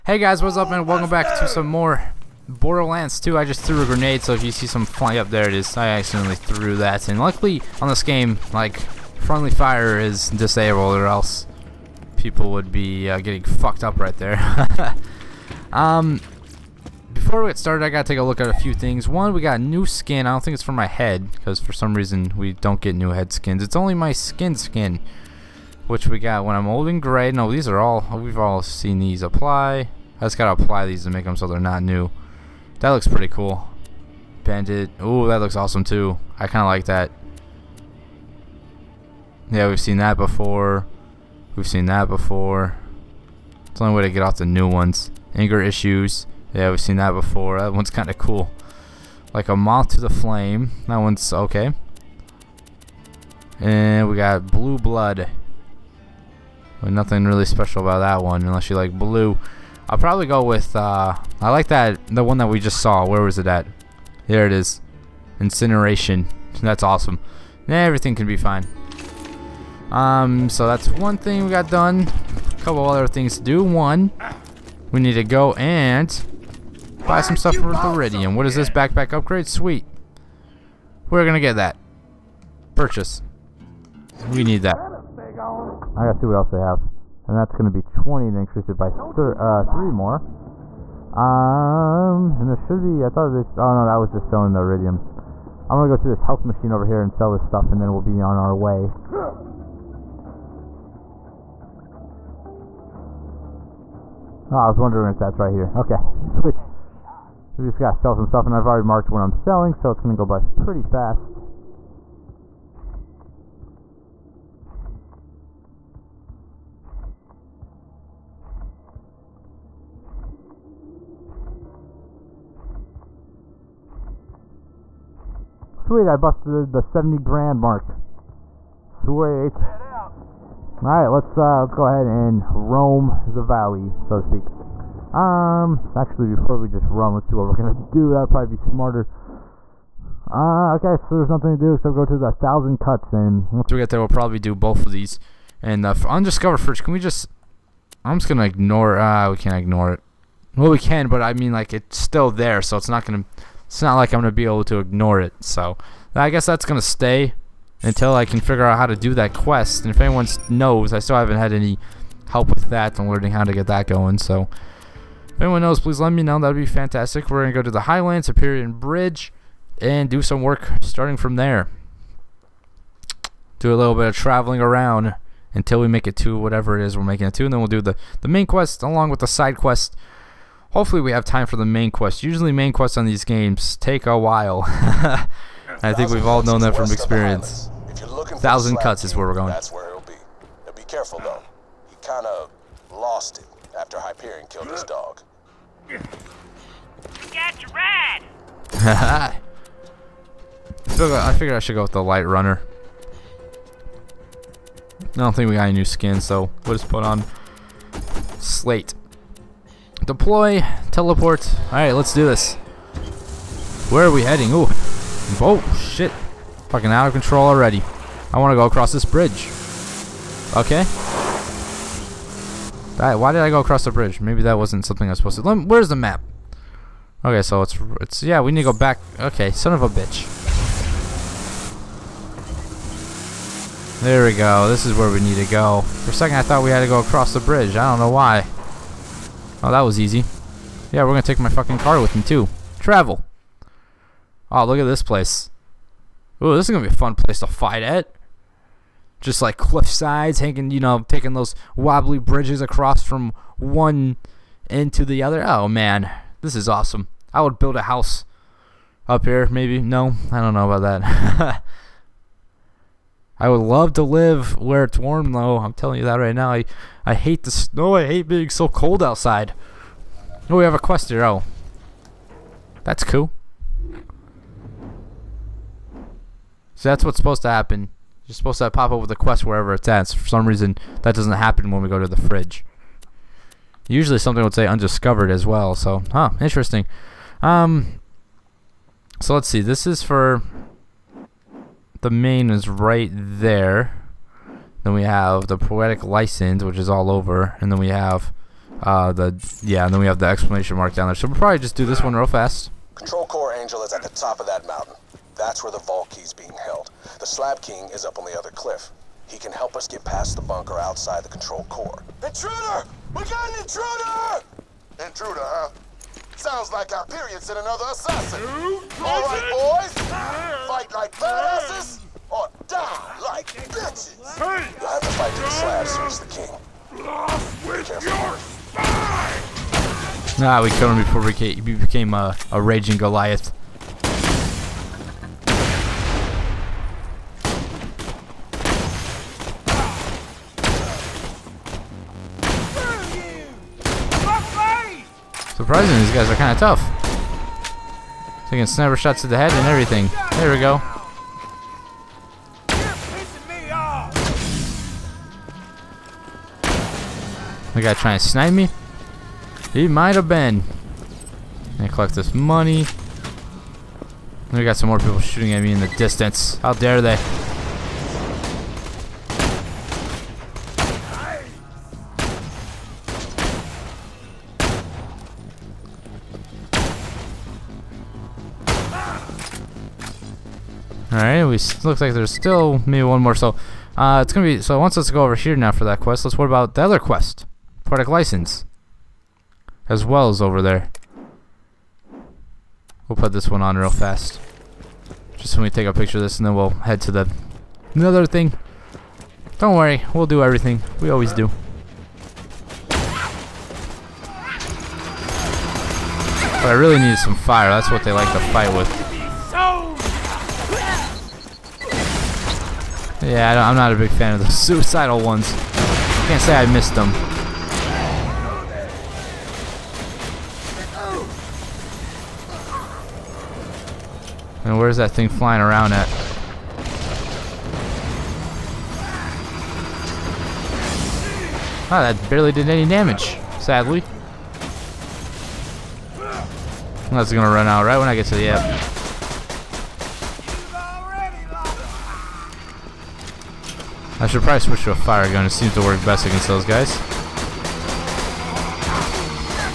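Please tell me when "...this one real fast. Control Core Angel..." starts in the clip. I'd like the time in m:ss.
5:01.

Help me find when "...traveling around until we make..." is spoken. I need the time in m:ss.
2:54.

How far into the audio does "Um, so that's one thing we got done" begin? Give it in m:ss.
1:09.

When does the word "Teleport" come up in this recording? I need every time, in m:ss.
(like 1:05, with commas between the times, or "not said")
3:30.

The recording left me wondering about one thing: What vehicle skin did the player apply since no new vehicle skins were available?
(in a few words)
Slate.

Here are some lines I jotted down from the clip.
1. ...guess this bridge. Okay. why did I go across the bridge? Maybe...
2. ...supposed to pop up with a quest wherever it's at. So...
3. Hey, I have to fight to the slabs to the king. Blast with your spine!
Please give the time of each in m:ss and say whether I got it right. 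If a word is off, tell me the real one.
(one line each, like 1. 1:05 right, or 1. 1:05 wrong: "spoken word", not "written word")
1. 3:38 wrong: "across", not "guess"
2. 4:38 right
3. 5:24 right.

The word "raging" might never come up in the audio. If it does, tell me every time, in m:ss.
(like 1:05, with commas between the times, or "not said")
5:32.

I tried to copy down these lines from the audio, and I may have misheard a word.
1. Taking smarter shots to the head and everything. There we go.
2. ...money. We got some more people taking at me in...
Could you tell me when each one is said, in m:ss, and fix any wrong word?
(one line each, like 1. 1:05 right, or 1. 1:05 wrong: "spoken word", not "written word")
1. 5:48 wrong: "sniper", not "smarter"
2. 6:02 wrong: "shooting", not "taking".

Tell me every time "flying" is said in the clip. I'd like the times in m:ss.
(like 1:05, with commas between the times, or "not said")
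0:04, 7:05.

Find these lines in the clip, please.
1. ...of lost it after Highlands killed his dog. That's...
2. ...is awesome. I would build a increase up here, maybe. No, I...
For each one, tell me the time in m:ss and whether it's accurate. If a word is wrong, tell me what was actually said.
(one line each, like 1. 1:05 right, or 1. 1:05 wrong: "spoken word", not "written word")
1. 3:12 wrong: "Hyperion", not "Highlands"
2. 4:16 wrong: "house", not "increase".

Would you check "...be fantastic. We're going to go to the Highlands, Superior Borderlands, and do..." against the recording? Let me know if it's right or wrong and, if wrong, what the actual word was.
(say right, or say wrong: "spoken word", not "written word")
wrong: "Bridge", not "Borderlands".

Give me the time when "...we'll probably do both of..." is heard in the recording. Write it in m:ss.
2:24.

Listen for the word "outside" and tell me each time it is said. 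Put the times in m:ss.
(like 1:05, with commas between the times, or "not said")
4:29, 5:10.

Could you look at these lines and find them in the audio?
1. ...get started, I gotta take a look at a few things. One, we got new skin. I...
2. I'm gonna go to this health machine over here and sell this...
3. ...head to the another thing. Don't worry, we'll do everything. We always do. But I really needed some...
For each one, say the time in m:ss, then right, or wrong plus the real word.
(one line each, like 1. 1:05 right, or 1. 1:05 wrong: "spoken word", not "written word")
1. 0:17 right
2. 1:35 right
3. 6:36 right.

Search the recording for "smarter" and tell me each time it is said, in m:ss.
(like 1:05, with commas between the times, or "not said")
2:18.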